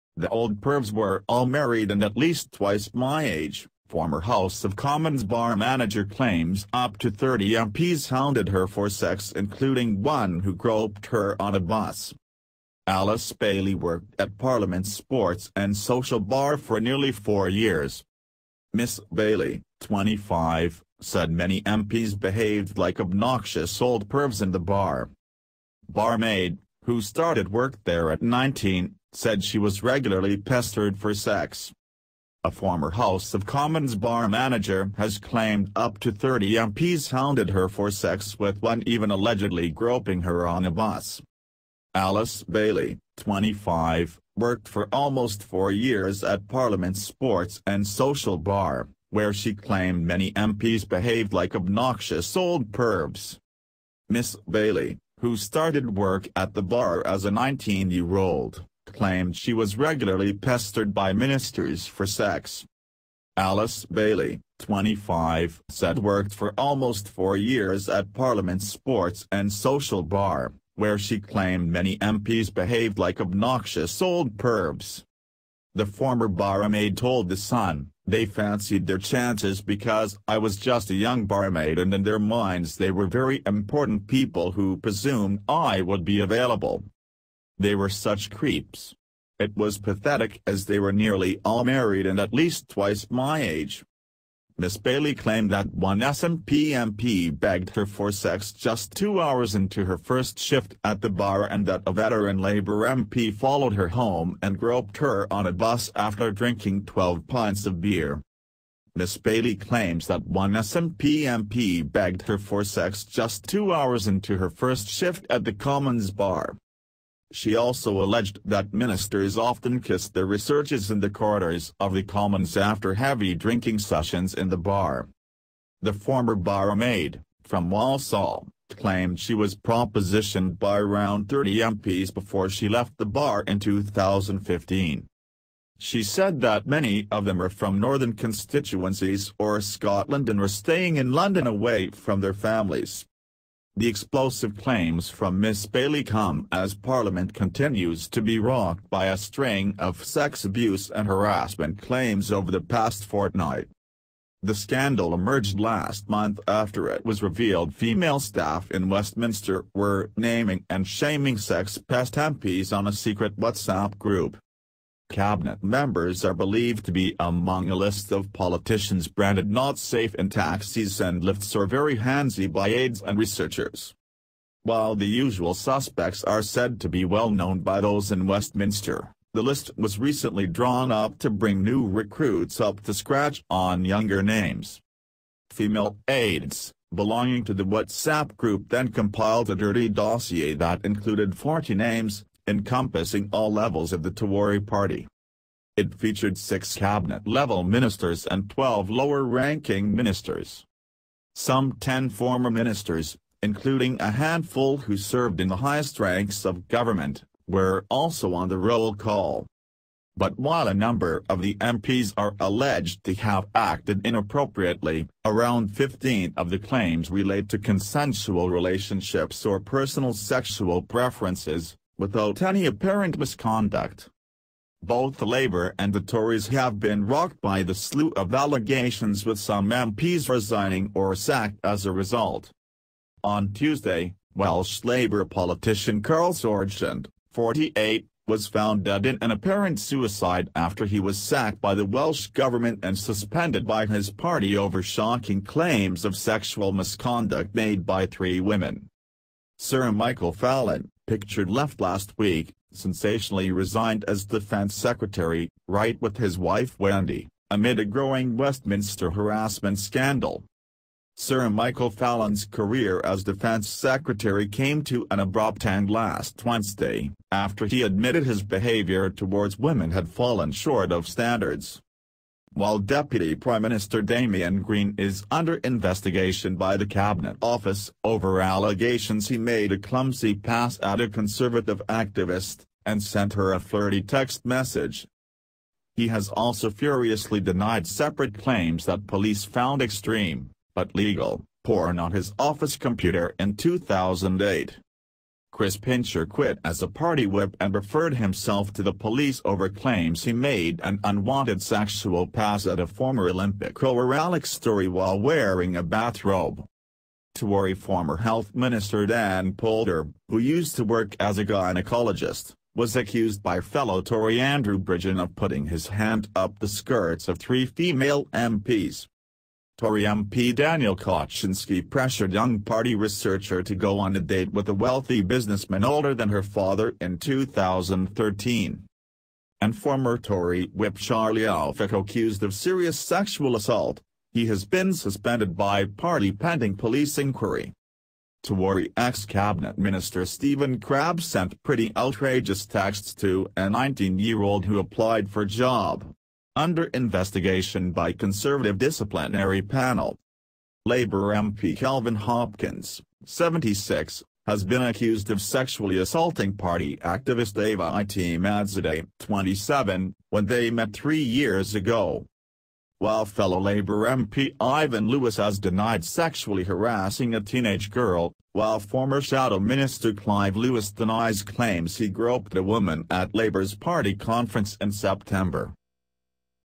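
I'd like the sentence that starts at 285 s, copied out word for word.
He has also furiously denied separate claims that police found extreme, but legal, porn on his office computer in 2008.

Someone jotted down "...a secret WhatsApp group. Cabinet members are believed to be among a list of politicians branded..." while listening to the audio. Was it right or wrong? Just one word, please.
right.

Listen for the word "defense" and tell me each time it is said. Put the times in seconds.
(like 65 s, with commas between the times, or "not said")
254 s, 263 s.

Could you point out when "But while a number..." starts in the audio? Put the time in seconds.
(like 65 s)
210 s.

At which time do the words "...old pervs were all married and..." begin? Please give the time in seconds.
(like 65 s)
0 s.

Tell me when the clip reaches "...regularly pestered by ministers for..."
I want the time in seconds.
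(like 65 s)
59 s.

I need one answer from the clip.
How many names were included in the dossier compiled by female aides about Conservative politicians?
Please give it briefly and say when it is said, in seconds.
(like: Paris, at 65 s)
40, at 191 s.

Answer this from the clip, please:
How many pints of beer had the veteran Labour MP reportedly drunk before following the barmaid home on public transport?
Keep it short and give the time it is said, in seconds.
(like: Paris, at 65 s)
12, at 106 s.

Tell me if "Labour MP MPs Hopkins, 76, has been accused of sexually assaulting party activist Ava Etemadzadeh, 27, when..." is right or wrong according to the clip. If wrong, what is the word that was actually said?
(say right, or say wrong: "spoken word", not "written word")
wrong: "Kelvin", not "MPs".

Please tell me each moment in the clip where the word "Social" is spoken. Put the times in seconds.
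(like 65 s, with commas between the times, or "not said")
15 s, 47 s, 69 s.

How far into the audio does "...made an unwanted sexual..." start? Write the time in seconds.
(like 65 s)
300 s.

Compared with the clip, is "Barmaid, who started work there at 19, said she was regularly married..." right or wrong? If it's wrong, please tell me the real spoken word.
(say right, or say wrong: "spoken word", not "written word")
wrong: "pestered", not "married".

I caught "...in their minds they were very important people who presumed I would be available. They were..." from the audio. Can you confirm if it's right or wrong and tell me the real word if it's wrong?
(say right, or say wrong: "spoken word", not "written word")
right.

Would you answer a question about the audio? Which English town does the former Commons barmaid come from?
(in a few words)
Walsall.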